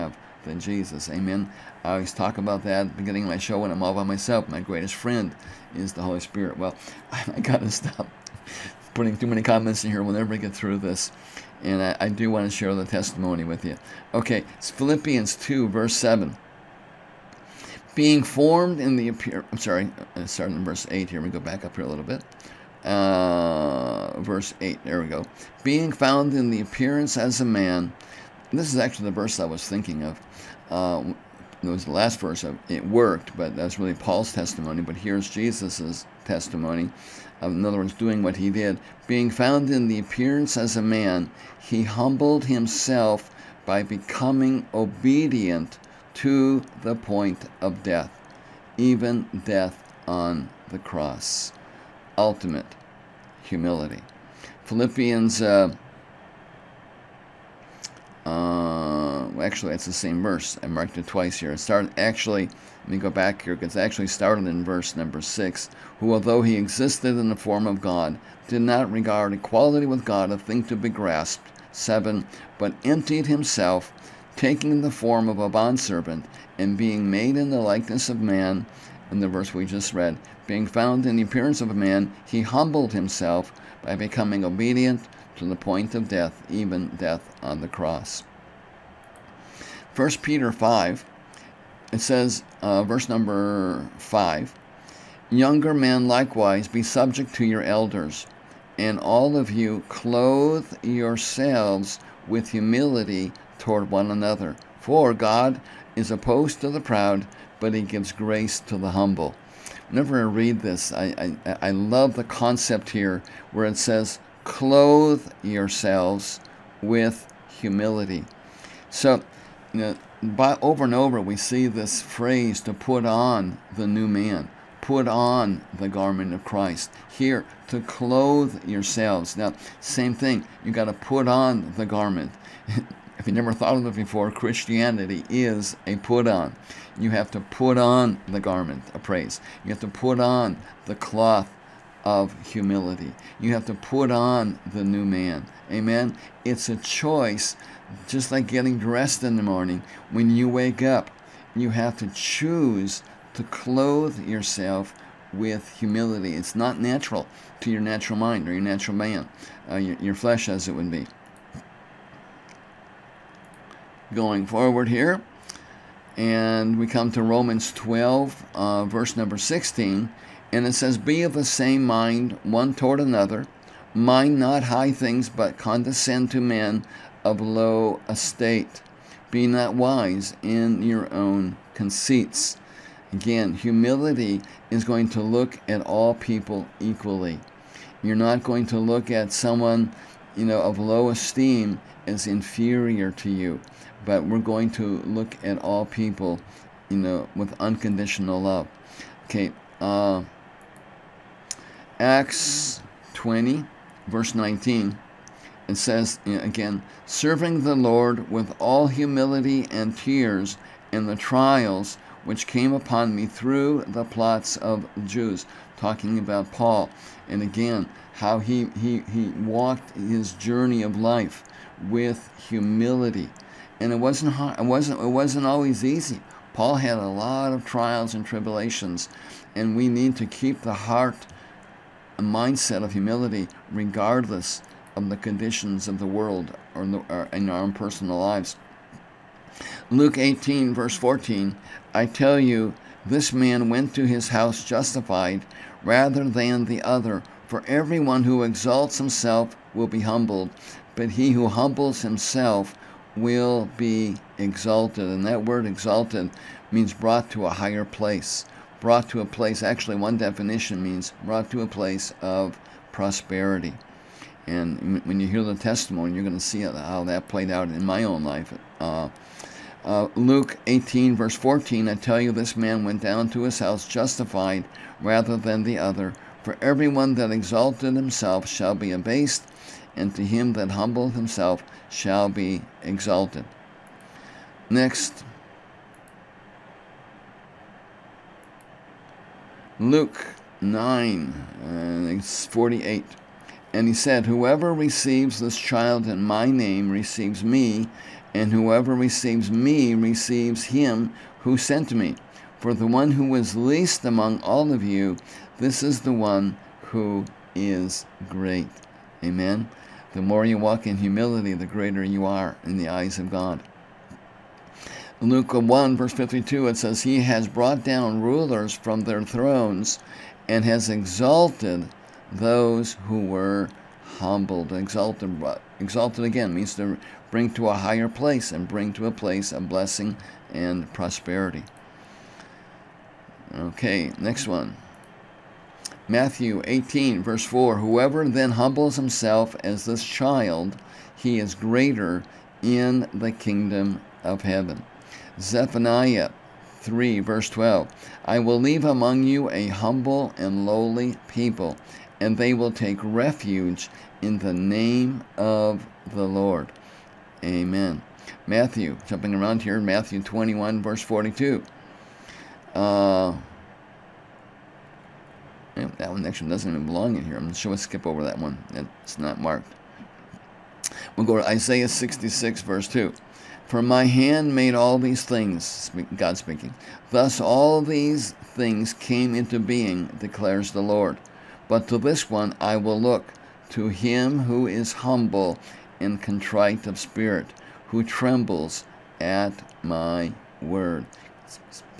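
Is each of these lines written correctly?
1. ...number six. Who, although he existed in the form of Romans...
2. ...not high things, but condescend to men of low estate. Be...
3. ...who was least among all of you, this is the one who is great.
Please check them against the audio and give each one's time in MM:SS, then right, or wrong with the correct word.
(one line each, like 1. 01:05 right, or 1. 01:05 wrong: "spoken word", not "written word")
1. 01:04 wrong: "God", not "Romans"
2. 02:54 right
3. 05:03 right.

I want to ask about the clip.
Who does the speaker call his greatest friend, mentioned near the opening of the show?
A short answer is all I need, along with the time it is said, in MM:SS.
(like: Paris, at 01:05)
The Holy Spirit, at 00:05.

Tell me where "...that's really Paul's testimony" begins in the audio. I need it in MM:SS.
00:33.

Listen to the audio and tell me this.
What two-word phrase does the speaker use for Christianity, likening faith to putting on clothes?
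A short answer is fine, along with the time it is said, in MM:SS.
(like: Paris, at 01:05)
a put on, at 02:15.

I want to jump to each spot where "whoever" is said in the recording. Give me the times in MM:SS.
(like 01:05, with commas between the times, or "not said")
04:54, 04:58, 05:37.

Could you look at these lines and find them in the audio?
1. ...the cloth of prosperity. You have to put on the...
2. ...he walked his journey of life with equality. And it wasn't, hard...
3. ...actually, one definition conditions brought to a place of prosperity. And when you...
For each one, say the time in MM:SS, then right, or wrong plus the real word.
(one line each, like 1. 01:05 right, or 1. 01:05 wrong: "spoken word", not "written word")
1. 02:20 wrong: "humility", not "prosperity"
2. 03:39 wrong: "humility", not "equality"
3. 04:19 wrong: "means", not "conditions".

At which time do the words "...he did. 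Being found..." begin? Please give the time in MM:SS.
00:38.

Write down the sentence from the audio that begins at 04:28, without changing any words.
Uh, uh, Luke 18, verse 14, I tell you, this man went down to his house justified rather than the other.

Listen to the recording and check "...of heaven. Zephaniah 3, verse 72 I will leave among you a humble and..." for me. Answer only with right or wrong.
wrong.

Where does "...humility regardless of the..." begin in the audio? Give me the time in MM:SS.
03:52.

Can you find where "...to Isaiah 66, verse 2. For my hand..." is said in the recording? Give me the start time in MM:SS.
06:11.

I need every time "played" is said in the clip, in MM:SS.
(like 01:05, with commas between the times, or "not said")
04:27.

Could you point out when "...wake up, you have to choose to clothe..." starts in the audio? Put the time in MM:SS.
02:30.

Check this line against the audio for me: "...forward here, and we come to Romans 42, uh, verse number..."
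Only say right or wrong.
wrong.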